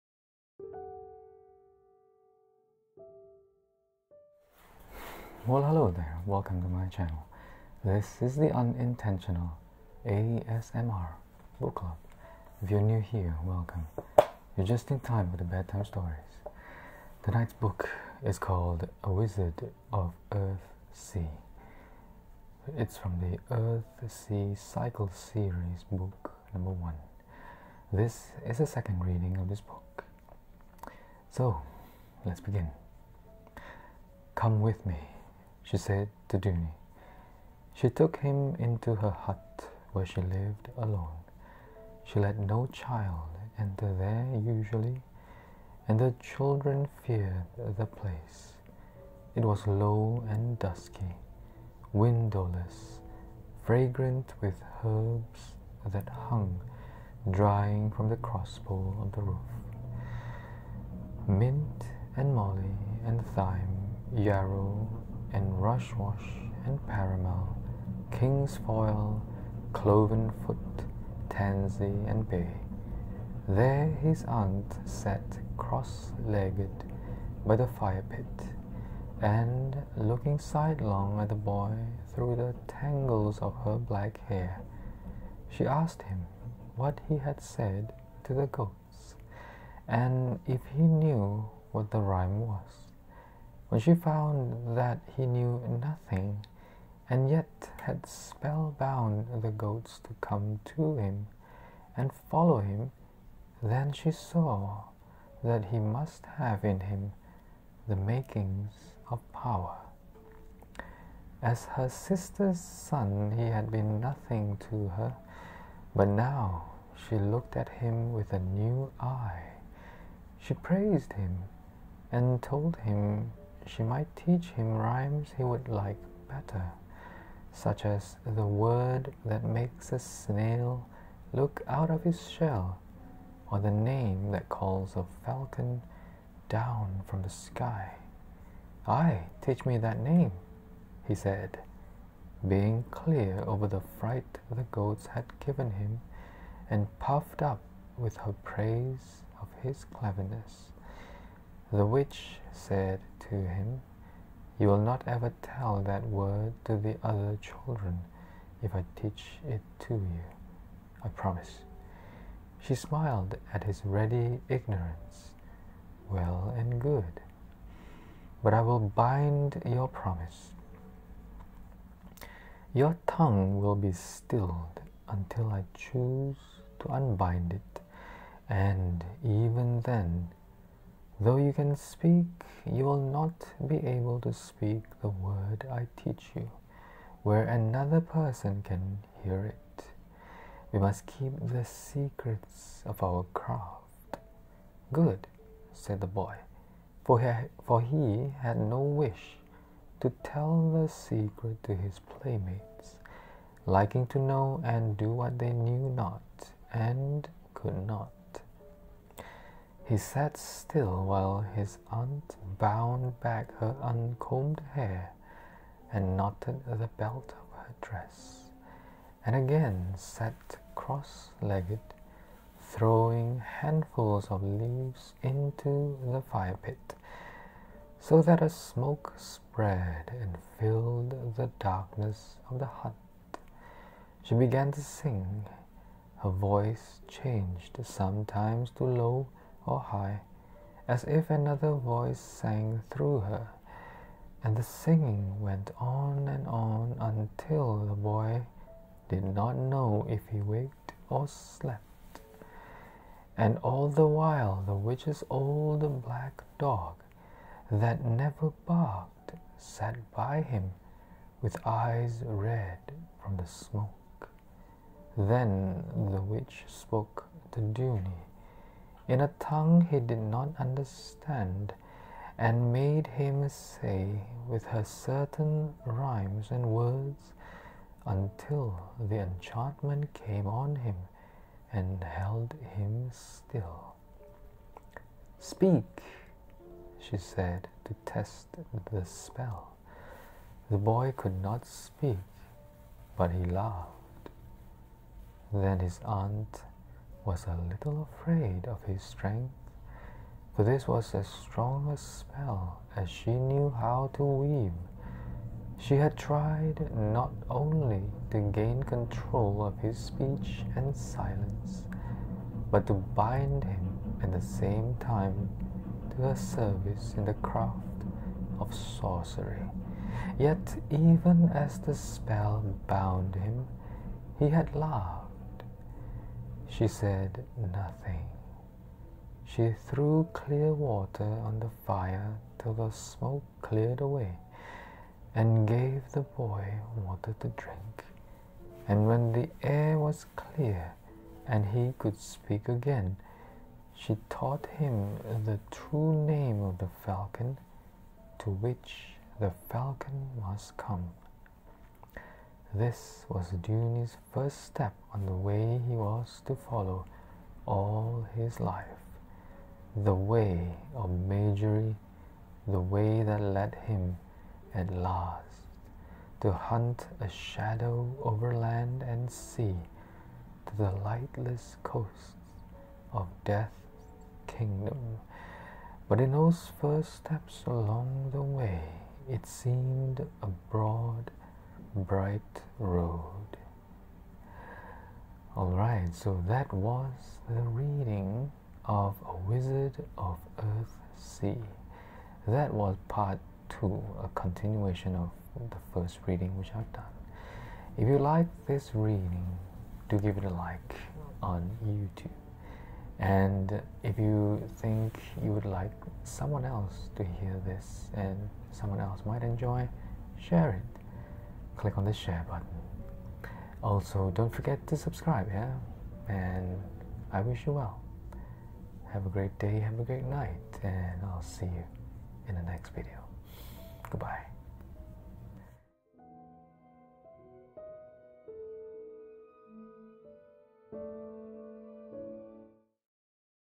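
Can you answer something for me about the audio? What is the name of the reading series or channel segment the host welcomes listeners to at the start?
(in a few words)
Unintentional ASMR Book Club.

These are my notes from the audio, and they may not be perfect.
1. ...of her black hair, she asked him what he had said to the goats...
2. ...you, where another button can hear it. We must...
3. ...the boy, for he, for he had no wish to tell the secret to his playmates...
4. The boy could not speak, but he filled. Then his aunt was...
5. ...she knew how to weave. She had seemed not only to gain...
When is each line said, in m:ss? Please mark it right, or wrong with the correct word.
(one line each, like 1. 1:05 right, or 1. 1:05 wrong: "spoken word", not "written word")
1. 1:23 right
2. 3:06 wrong: "person", not "button"
3. 3:16 right
4. 4:50 wrong: "laughed", not "filled"
5. 5:03 wrong: "tried", not "seemed".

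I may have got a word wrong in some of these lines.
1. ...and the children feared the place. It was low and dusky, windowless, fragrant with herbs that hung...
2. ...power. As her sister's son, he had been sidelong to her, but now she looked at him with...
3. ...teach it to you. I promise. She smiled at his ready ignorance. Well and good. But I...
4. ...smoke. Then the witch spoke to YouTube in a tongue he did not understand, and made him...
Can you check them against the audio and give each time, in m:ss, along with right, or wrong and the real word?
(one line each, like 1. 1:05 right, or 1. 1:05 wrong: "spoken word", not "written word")
1. 0:45 right
2. 1:49 wrong: "nothing", not "sidelong"
3. 2:39 right
4. 4:23 wrong: "Duny", not "YouTube".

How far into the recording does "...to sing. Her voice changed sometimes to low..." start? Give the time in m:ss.
3:54.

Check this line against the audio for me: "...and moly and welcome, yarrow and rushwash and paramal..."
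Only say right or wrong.
wrong.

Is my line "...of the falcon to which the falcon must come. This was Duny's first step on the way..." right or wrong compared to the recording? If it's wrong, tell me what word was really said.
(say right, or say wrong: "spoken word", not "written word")
right.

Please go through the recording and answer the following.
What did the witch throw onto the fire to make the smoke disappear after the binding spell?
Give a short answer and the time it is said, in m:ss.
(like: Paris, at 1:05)
Clear water, at 5:30.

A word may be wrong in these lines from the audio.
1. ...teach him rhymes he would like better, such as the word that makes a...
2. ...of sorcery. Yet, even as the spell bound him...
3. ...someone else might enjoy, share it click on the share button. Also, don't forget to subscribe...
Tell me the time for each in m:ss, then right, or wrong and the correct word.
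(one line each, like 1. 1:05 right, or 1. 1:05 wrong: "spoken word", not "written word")
1. 2:04 right
2. 5:18 right
3. 6:48 right.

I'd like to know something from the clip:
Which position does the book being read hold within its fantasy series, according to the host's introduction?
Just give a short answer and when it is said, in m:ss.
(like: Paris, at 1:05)
Book number one, at 0:25.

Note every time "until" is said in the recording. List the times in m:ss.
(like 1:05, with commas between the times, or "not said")
2:55, 4:06, 4:38.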